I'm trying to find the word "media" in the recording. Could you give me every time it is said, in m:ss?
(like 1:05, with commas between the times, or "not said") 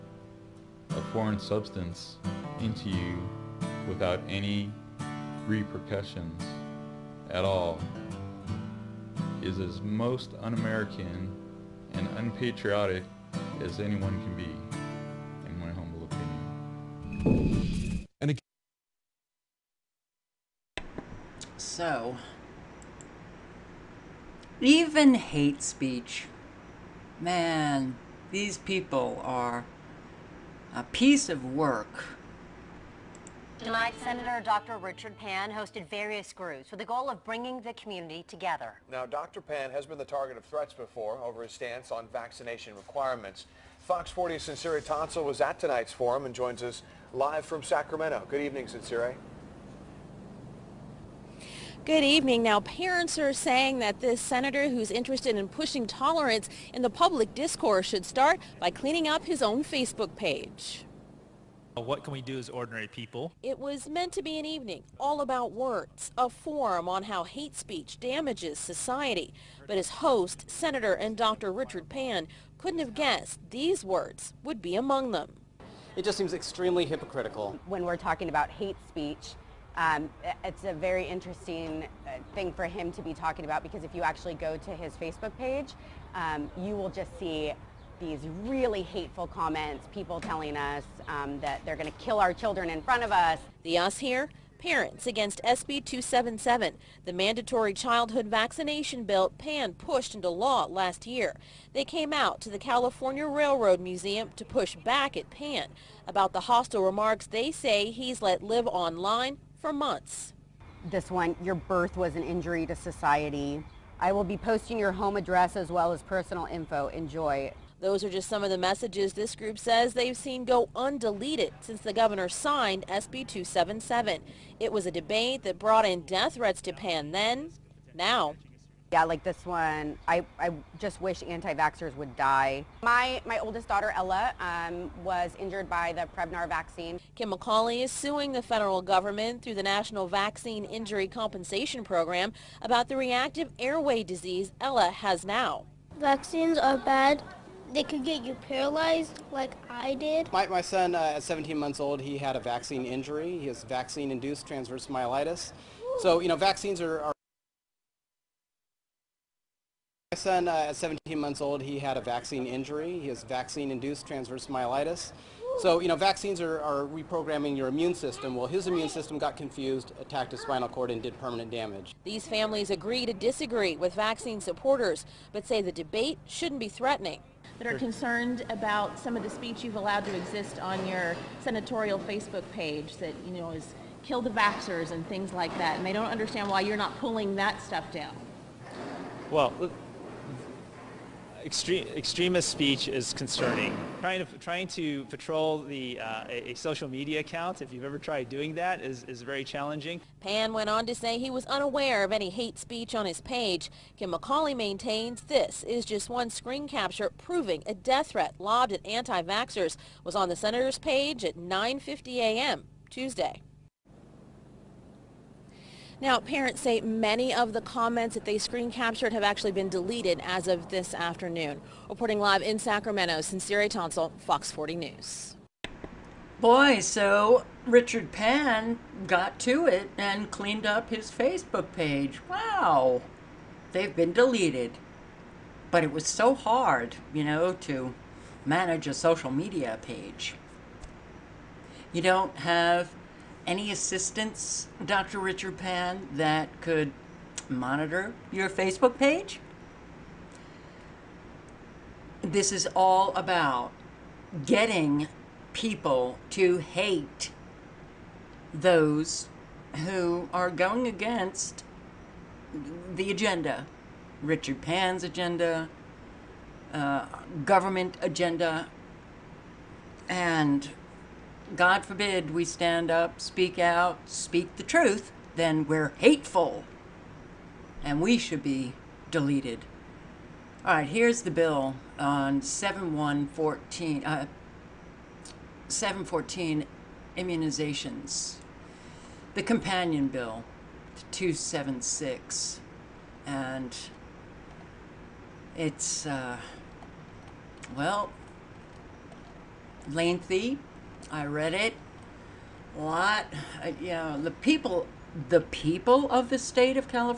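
3:16, 3:59.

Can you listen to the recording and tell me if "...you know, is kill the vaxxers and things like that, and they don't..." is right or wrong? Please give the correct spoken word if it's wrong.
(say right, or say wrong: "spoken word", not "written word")
right.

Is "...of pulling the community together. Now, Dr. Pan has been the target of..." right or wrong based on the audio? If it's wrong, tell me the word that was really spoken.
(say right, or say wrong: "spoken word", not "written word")
wrong: "bringing", not "pulling".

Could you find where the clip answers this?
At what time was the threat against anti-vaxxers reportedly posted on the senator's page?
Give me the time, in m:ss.
3:31.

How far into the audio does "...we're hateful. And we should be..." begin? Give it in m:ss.
4:35.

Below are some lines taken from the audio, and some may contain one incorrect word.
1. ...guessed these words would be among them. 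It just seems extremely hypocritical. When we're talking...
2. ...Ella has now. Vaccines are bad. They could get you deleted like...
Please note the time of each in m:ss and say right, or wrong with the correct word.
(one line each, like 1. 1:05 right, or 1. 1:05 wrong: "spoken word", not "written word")
1. 1:12 right
2. 2:24 wrong: "paralyzed", not "deleted".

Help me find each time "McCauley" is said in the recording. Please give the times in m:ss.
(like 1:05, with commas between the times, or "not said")
2:17, 3:24.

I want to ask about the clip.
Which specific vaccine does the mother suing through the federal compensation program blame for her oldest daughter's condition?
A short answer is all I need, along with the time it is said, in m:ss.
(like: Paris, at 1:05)
Prevnar, at 2:16.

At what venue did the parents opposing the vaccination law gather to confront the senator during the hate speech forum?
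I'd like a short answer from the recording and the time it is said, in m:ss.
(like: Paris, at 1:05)
California Railroad Museum, at 1:42.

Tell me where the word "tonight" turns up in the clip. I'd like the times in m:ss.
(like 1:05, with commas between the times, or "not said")
0:33, 0:45.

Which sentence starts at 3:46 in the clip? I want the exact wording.
Boy, so Richard Pan got to it and cleaned up his Facebook page.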